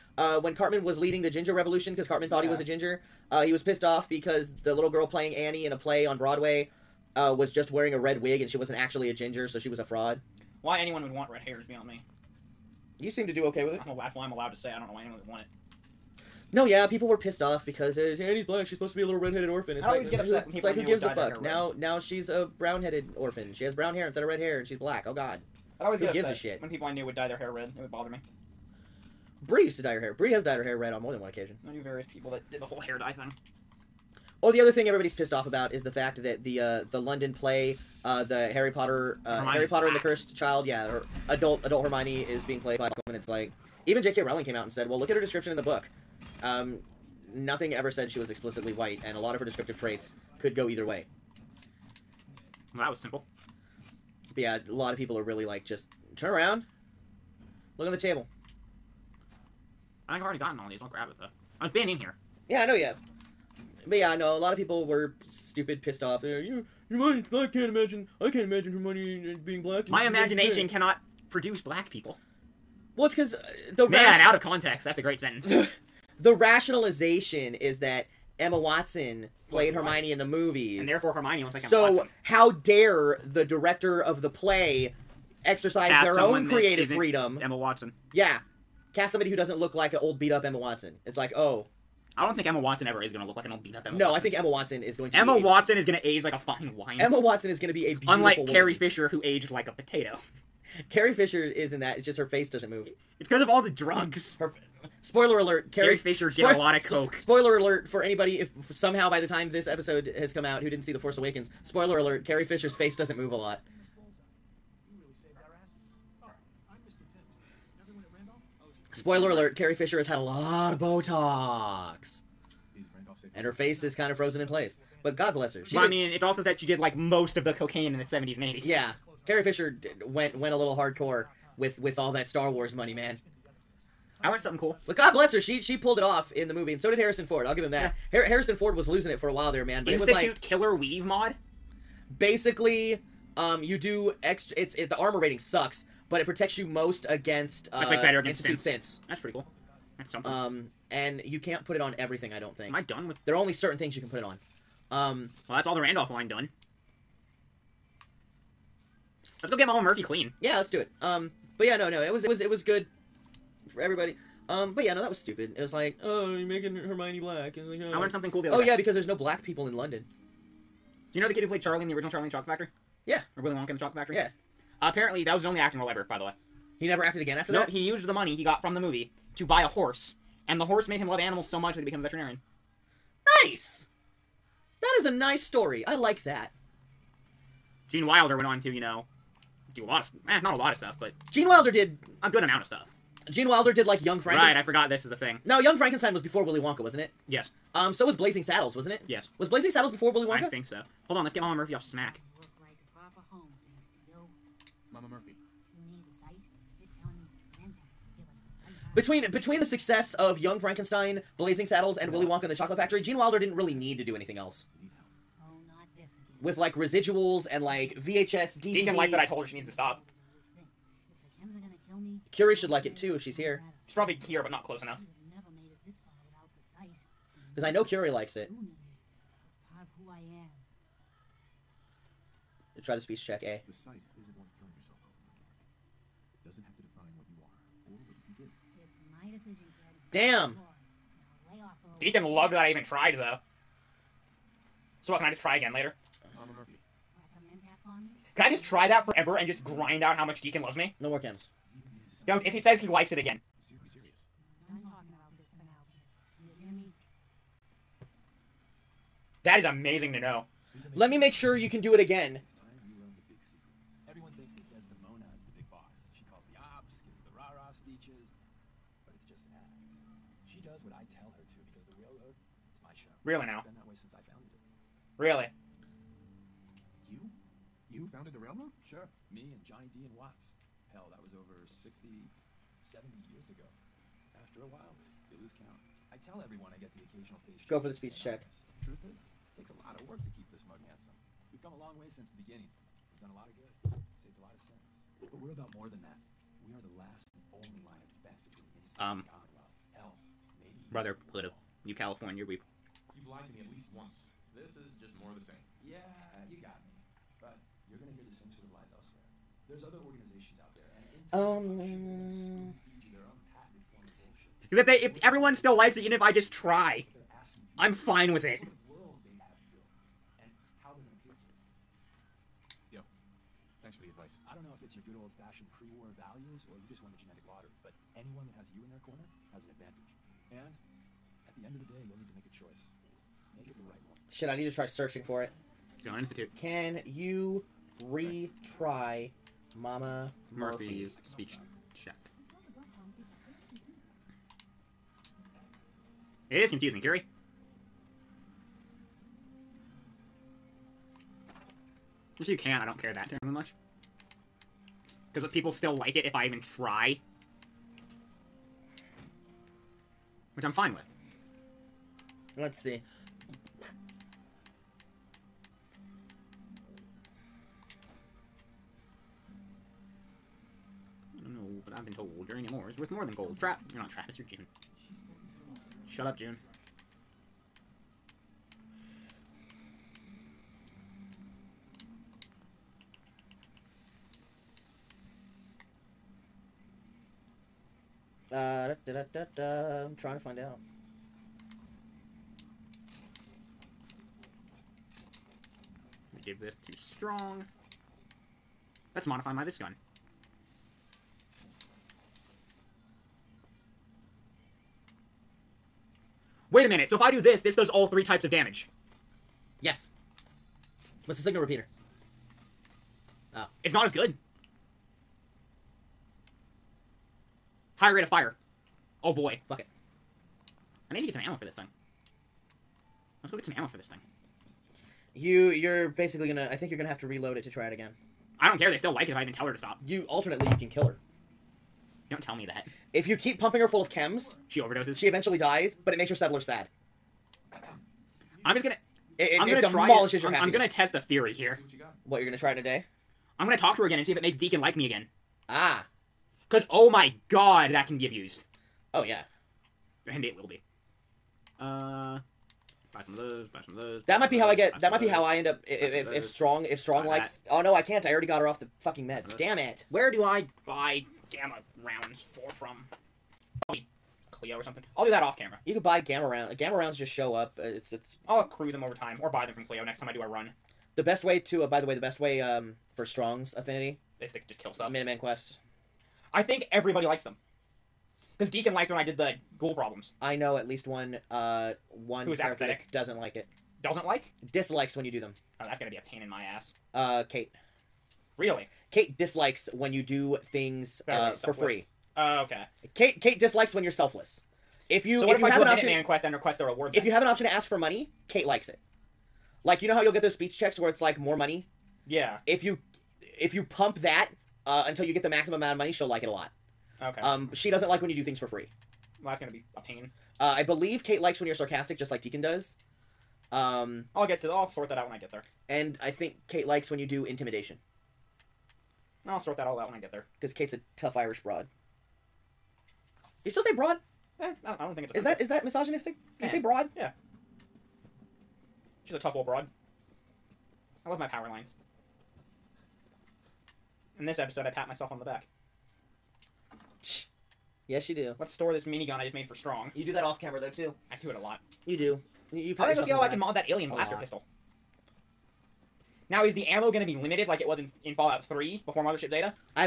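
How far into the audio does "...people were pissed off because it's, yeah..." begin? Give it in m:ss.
0:16.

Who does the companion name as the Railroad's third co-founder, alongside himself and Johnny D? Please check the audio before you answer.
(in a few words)
Watts.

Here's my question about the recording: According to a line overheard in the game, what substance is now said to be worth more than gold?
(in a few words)
Uranium.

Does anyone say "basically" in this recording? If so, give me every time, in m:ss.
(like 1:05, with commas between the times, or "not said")
2:22, 7:06.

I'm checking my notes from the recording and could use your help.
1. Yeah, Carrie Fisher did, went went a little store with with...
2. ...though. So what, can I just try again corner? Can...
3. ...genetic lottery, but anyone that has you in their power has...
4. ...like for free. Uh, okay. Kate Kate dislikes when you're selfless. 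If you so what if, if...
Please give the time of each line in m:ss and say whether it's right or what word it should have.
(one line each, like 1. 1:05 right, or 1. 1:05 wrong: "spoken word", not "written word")
1. 2:08 wrong: "hardcore", not "store"
2. 4:03 wrong: "later", not "corner"
3. 5:27 wrong: "corner", not "power"
4. 8:11 right.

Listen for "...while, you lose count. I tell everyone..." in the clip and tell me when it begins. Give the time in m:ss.
4:44.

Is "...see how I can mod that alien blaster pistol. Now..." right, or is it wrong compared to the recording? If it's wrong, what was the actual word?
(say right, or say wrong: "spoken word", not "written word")
right.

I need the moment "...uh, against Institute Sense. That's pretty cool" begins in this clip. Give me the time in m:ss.
2:28.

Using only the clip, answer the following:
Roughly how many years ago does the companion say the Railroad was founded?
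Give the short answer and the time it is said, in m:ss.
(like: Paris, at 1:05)
60, 70 years, at 4:41.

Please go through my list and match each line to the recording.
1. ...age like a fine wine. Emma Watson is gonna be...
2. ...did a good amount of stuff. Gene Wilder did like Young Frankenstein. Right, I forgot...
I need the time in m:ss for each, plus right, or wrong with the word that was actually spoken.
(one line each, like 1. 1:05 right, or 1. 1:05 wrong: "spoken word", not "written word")
1. 1:36 right
2. 3:11 right.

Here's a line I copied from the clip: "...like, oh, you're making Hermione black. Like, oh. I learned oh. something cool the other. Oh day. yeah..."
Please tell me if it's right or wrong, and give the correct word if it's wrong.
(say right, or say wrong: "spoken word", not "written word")
right.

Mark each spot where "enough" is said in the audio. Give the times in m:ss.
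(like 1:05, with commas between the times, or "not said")
3:44.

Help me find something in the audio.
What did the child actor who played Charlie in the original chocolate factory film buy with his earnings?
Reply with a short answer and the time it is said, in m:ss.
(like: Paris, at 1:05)
A horse, at 2:59.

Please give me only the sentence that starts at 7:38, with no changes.
I already got her off the Fucking meds.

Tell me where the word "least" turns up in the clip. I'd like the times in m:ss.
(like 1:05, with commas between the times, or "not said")
5:03, 8:00.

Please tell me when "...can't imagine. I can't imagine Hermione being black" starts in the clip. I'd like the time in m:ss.
1:07.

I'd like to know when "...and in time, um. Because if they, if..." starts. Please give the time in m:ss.
5:10.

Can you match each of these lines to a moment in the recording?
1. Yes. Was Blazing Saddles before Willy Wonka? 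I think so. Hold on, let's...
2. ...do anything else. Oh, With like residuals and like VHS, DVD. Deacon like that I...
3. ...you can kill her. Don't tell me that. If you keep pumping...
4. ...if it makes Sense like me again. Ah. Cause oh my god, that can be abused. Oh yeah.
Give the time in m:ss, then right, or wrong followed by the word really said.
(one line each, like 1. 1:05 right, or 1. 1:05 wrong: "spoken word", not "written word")
1. 3:19 right
2. 3:34 right
3. 7:10 right
4. 7:24 wrong: "Deacon", not "Sense".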